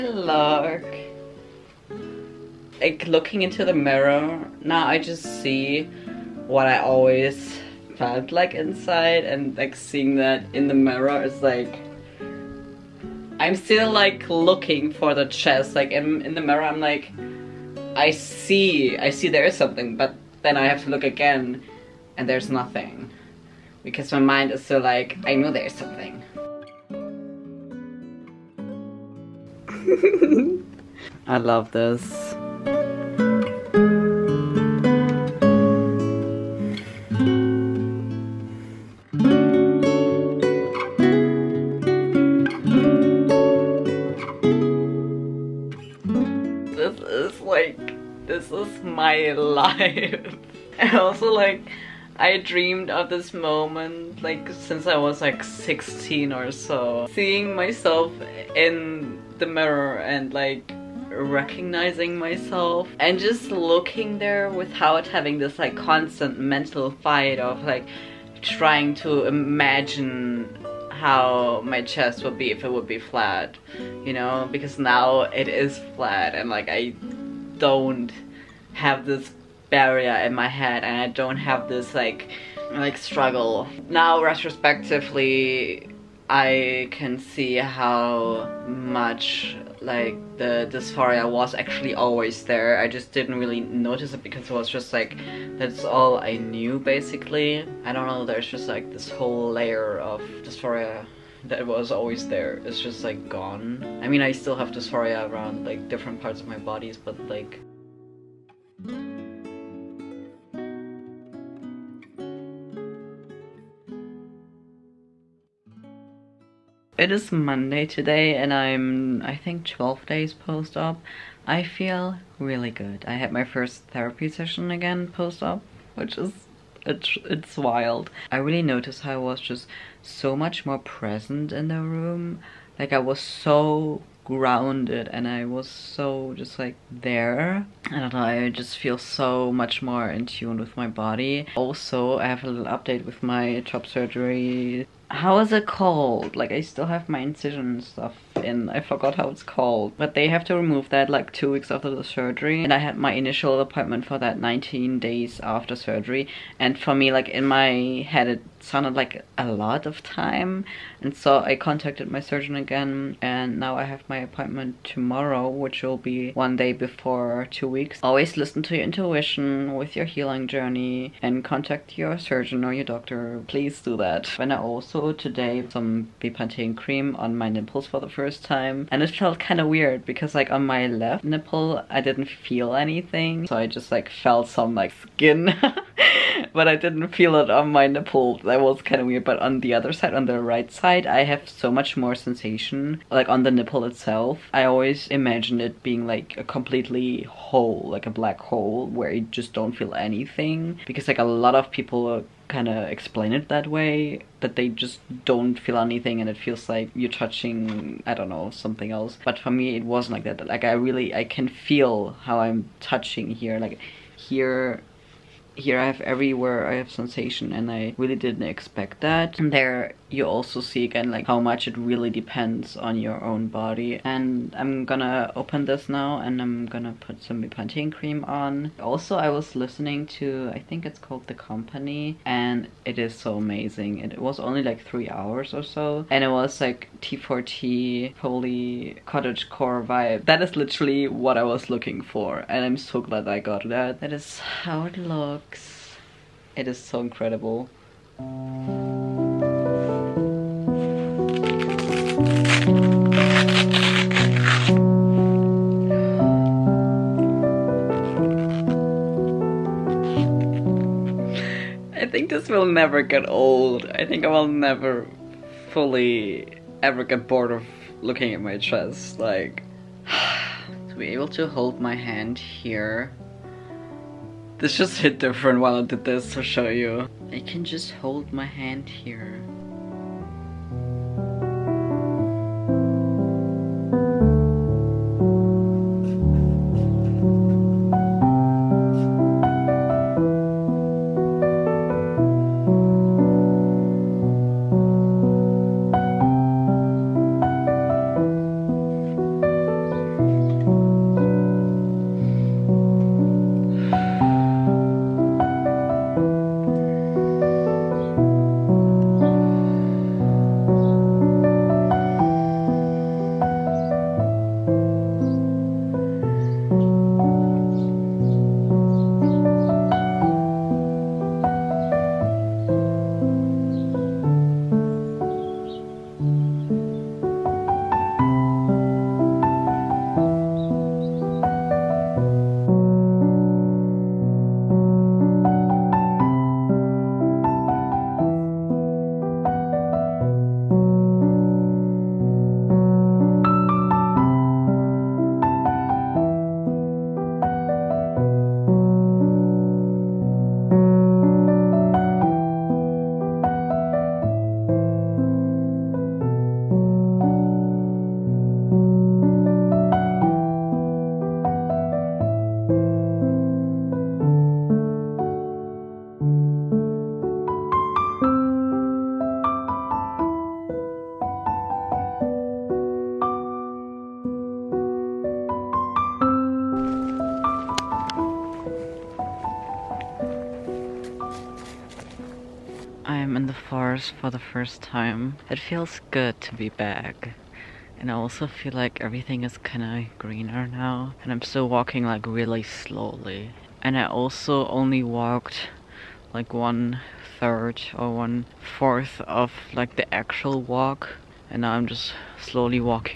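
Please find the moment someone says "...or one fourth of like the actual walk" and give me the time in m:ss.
6:37.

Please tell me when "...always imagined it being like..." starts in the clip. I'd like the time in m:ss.
3:14.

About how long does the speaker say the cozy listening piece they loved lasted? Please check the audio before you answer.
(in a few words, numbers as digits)
3 hours.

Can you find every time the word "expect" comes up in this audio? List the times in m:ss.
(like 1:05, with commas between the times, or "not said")
3:38.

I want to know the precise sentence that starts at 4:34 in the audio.
This just hit different while I did this to show you.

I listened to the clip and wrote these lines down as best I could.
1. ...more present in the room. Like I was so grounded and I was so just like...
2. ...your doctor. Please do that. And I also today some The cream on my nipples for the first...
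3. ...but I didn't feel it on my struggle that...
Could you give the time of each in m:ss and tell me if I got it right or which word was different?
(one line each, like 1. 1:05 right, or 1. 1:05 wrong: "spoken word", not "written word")
1. 2:10 right
2. 2:52 wrong: "Bepanthen", not "The"
3. 3:06 wrong: "nipple", not "struggle".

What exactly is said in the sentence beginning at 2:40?
And so I contacted my surgeon again.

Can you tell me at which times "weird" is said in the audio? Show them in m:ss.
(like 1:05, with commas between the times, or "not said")
2:59, 3:09.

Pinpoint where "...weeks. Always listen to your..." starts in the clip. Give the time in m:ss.
2:47.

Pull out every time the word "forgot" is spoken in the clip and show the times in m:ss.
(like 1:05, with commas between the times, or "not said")
2:28.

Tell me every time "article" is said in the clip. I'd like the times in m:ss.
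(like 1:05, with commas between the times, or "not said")
not said.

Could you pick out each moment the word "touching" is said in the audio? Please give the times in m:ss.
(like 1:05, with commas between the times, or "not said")
3:27, 3:32.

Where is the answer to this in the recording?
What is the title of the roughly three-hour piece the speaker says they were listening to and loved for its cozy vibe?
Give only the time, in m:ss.
3:51.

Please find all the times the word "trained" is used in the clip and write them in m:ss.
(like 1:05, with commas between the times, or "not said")
not said.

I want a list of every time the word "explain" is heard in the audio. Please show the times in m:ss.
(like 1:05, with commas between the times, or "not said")
3:22.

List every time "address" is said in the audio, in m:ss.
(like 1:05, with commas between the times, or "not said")
not said.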